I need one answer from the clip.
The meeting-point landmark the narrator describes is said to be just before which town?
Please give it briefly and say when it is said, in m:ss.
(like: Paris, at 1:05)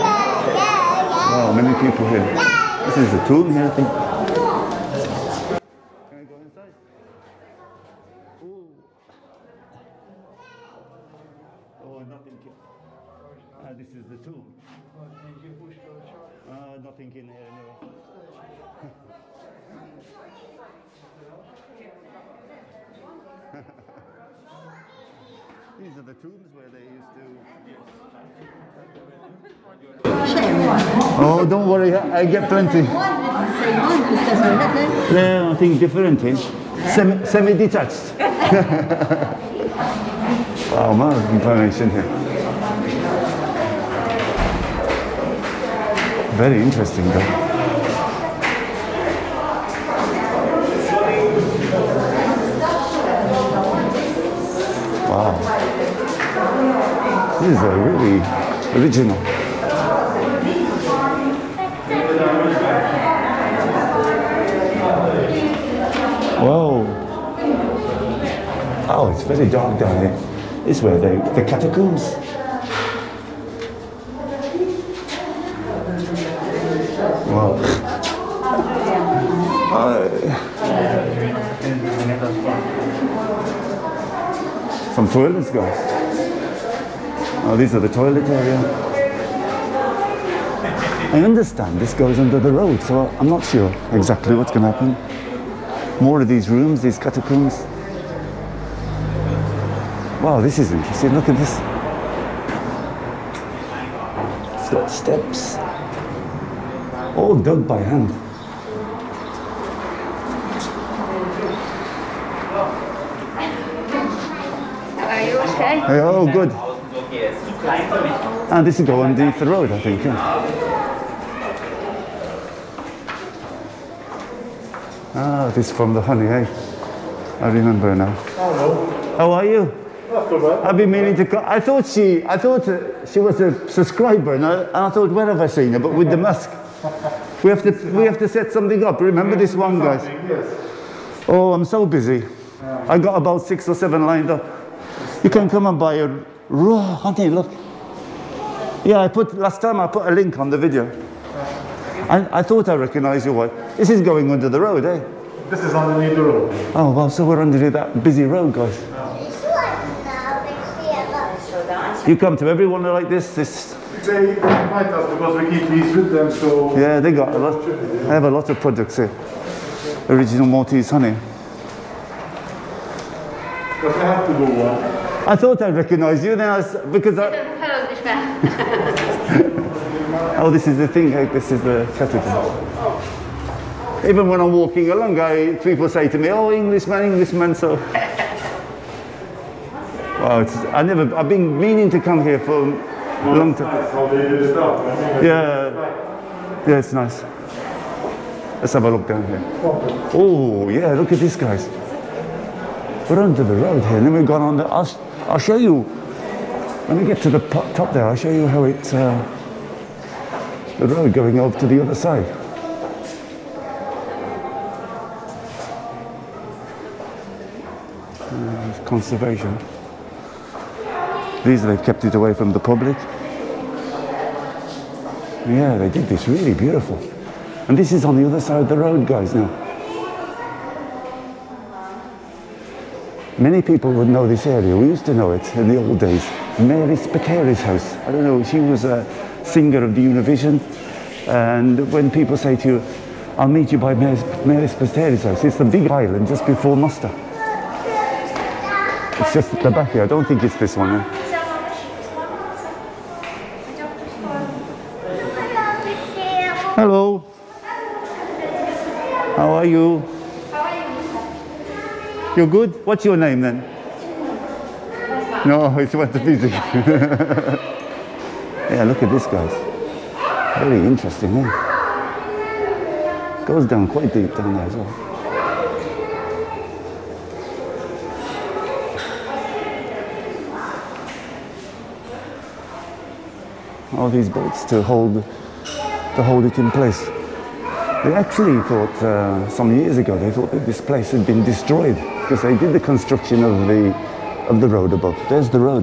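Mosta, at 4:06.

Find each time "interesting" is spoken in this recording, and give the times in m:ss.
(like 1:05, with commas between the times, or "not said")
0:46, 1:40, 4:30.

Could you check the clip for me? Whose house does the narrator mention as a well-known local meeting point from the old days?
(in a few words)
Mary Spiteri's.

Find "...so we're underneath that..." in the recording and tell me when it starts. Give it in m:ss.
2:37.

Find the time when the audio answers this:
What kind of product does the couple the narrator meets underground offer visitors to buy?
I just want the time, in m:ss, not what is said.
2:26.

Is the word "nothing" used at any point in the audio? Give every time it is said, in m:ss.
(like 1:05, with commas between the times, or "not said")
0:12, 0:16.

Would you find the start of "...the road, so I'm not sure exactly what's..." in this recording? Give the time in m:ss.
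1:32.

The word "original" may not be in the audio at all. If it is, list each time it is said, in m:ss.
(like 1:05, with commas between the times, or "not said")
0:58, 2:50.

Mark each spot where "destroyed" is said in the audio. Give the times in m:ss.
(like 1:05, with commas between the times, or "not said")
4:51.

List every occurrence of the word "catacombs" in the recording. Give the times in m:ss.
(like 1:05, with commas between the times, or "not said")
1:11, 1:36.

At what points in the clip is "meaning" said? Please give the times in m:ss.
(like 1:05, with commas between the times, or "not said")
2:10, 3:11.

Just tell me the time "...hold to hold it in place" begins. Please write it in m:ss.
4:44.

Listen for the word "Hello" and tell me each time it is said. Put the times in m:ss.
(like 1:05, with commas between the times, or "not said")
2:08, 4:16.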